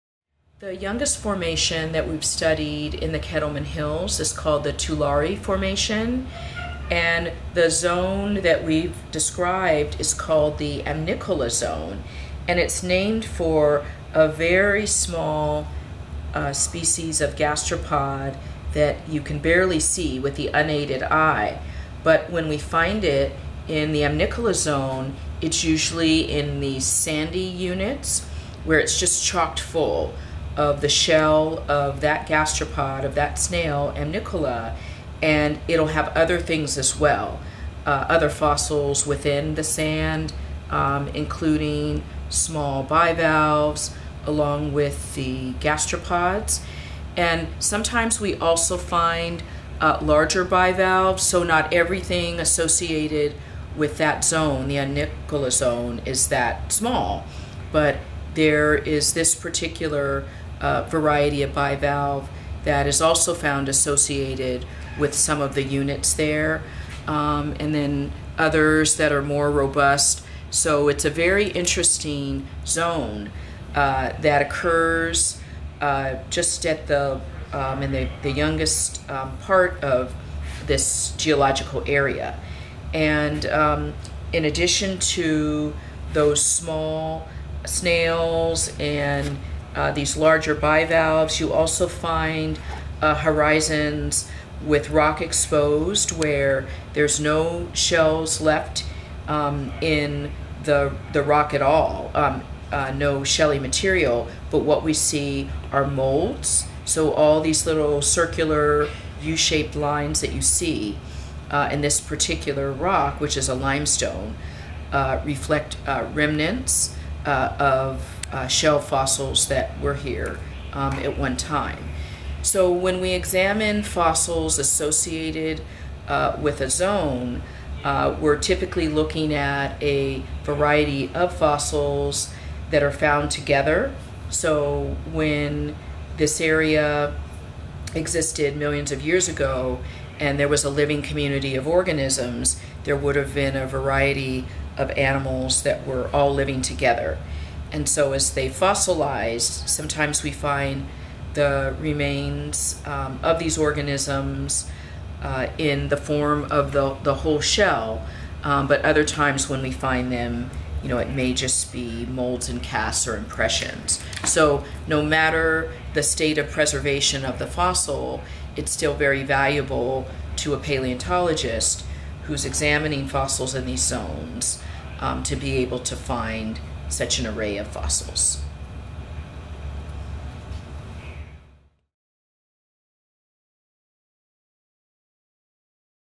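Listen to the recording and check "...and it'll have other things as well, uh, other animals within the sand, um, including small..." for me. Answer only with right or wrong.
wrong.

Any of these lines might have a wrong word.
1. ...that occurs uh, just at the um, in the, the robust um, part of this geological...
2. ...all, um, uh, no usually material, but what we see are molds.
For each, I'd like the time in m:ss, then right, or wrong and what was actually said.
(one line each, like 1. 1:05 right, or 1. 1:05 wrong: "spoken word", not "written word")
1. 1:14 wrong: "youngest", not "robust"
2. 1:41 wrong: "shelly", not "usually".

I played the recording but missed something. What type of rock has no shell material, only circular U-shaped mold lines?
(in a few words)
limestone.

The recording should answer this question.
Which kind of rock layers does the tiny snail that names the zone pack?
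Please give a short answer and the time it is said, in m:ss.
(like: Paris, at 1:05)
sandy units, at 0:26.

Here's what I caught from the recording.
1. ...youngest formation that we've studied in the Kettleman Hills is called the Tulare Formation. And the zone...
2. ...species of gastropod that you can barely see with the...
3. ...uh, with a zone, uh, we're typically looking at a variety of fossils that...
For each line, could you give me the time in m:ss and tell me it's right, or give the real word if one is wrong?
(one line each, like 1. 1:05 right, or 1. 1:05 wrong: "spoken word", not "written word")
1. 0:00 right
2. 0:16 right
3. 2:06 right.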